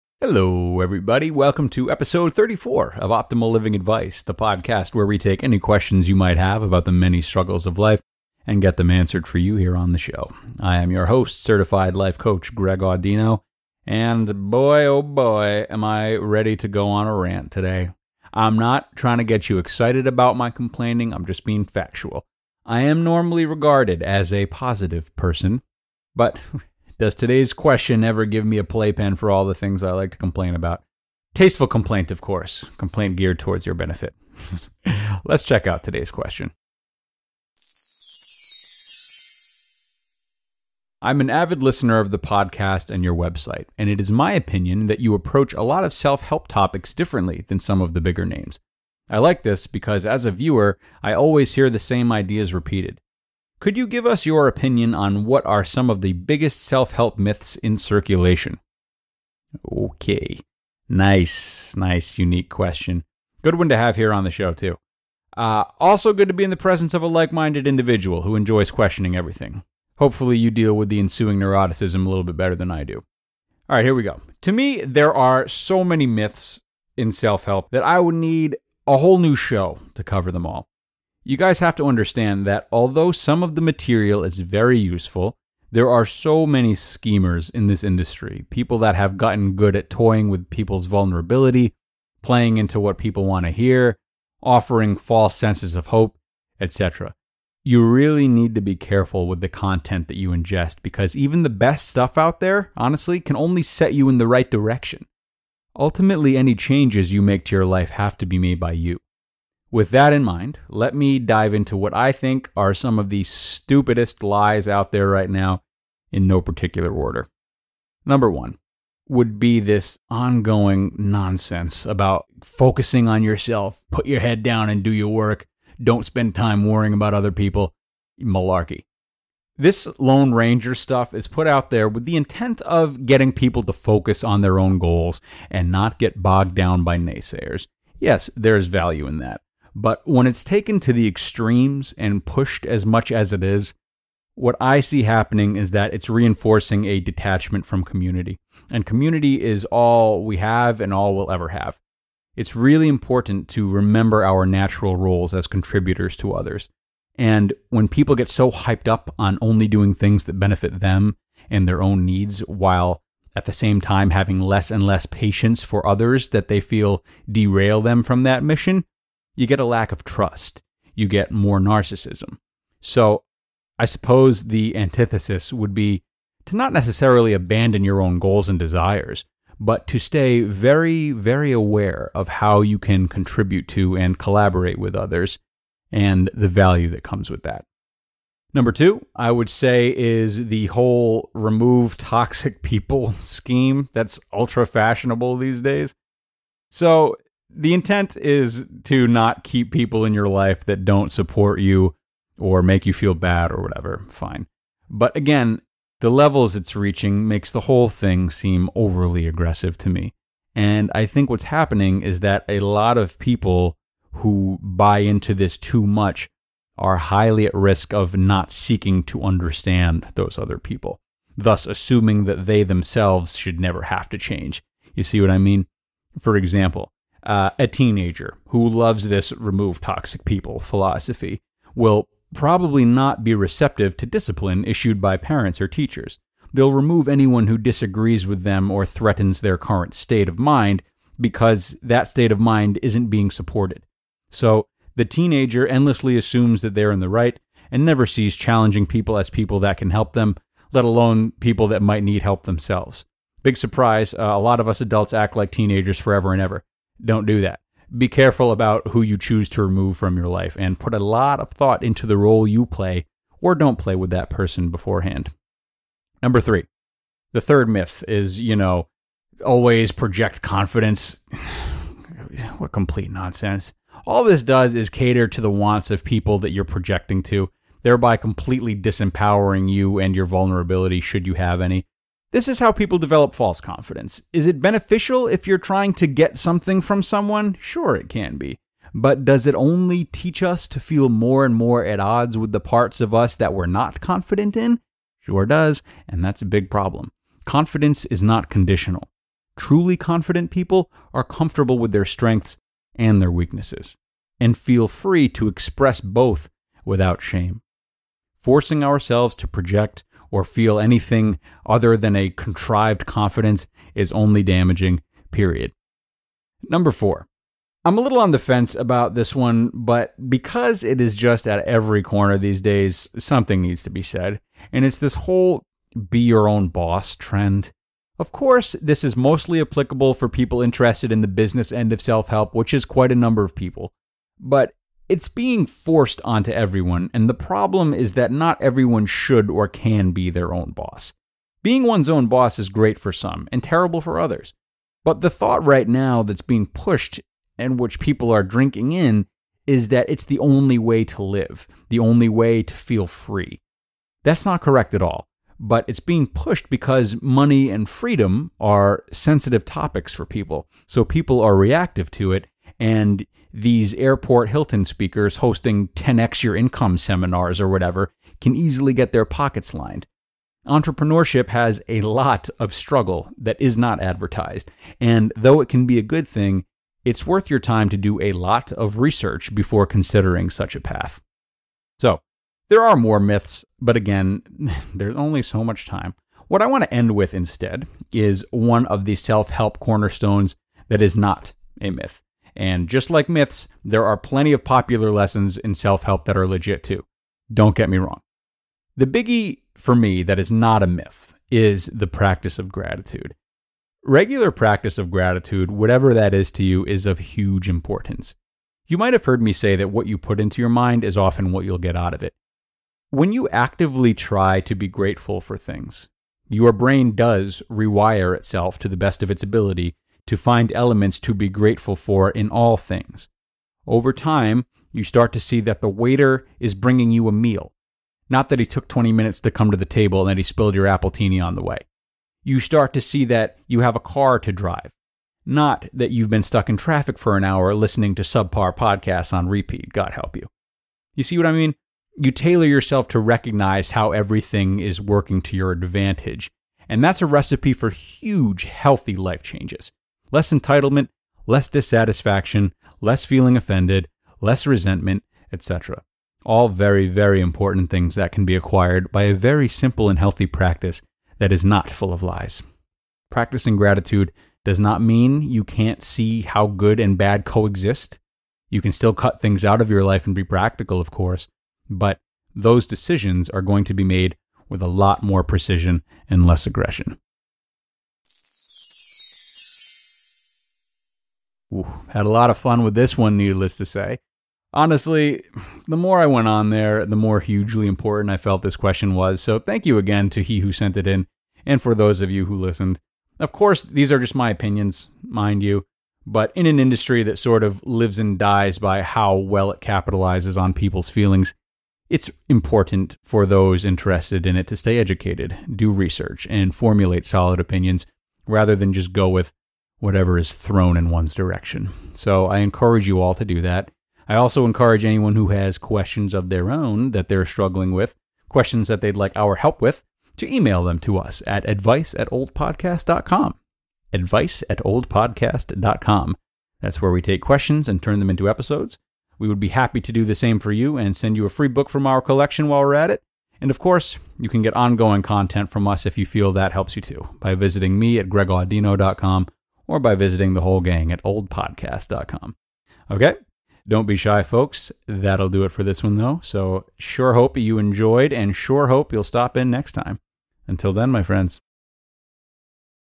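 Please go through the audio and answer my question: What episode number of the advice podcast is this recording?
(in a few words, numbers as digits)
34.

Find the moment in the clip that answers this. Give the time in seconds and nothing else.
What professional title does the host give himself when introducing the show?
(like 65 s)
11 s.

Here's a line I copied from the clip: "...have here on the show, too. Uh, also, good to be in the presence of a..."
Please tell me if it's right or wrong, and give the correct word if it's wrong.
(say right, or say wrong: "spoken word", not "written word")
right.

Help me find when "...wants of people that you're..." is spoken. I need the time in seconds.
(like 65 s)
275 s.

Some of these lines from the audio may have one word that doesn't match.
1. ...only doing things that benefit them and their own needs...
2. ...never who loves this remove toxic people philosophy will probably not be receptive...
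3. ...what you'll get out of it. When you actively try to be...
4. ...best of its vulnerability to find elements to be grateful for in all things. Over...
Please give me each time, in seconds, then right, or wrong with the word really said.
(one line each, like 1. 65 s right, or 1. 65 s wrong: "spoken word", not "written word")
1. 159 s right
2. 227 s wrong: "teenager", not "never"
3. 411 s right
4. 418 s wrong: "ability", not "vulnerability".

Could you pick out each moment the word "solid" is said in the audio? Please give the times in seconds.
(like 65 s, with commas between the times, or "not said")
507 s.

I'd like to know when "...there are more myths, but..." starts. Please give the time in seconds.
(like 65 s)
382 s.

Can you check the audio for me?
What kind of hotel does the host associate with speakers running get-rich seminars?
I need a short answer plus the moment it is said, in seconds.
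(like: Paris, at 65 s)
airport Hilton, at 363 s.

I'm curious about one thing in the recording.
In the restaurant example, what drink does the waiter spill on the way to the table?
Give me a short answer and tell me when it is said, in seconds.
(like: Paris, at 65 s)
appletini, at 430 s.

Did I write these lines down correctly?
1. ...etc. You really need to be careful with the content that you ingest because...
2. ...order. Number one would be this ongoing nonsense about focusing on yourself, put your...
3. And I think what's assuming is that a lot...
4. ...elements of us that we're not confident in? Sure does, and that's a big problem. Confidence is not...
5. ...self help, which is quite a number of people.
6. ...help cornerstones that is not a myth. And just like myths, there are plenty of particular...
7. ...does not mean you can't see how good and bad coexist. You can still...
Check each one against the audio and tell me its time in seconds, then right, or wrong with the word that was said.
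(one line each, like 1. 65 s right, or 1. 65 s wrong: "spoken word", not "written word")
1. 96 s right
2. 116 s right
3. 210 s wrong: "happening", not "assuming"
4. 292 s wrong: "parts", not "elements"
5. 331 s right
6. 389 s wrong: "popular", not "particular"
7. 464 s right.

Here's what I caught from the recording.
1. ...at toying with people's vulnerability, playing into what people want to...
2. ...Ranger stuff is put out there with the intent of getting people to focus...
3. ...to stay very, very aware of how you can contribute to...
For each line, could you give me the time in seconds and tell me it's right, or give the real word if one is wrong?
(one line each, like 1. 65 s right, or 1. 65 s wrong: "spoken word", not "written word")
1. 89 s right
2. 130 s right
3. 179 s right.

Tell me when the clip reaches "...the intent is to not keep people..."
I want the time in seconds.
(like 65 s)
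197 s.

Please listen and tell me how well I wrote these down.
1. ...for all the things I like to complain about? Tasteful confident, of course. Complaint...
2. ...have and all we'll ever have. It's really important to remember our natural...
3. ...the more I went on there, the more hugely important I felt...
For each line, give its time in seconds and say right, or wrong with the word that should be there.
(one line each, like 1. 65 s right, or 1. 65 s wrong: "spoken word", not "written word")
1. 29 s wrong: "complaint", not "confident"
2. 150 s right
3. 485 s right.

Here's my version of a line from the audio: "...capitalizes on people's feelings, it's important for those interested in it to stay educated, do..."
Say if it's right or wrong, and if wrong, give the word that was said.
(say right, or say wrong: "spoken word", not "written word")
right.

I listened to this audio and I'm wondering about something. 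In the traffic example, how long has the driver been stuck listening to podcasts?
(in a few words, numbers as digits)
an hour.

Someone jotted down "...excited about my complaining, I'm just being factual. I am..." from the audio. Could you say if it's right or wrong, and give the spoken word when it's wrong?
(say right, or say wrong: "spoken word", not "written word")
right.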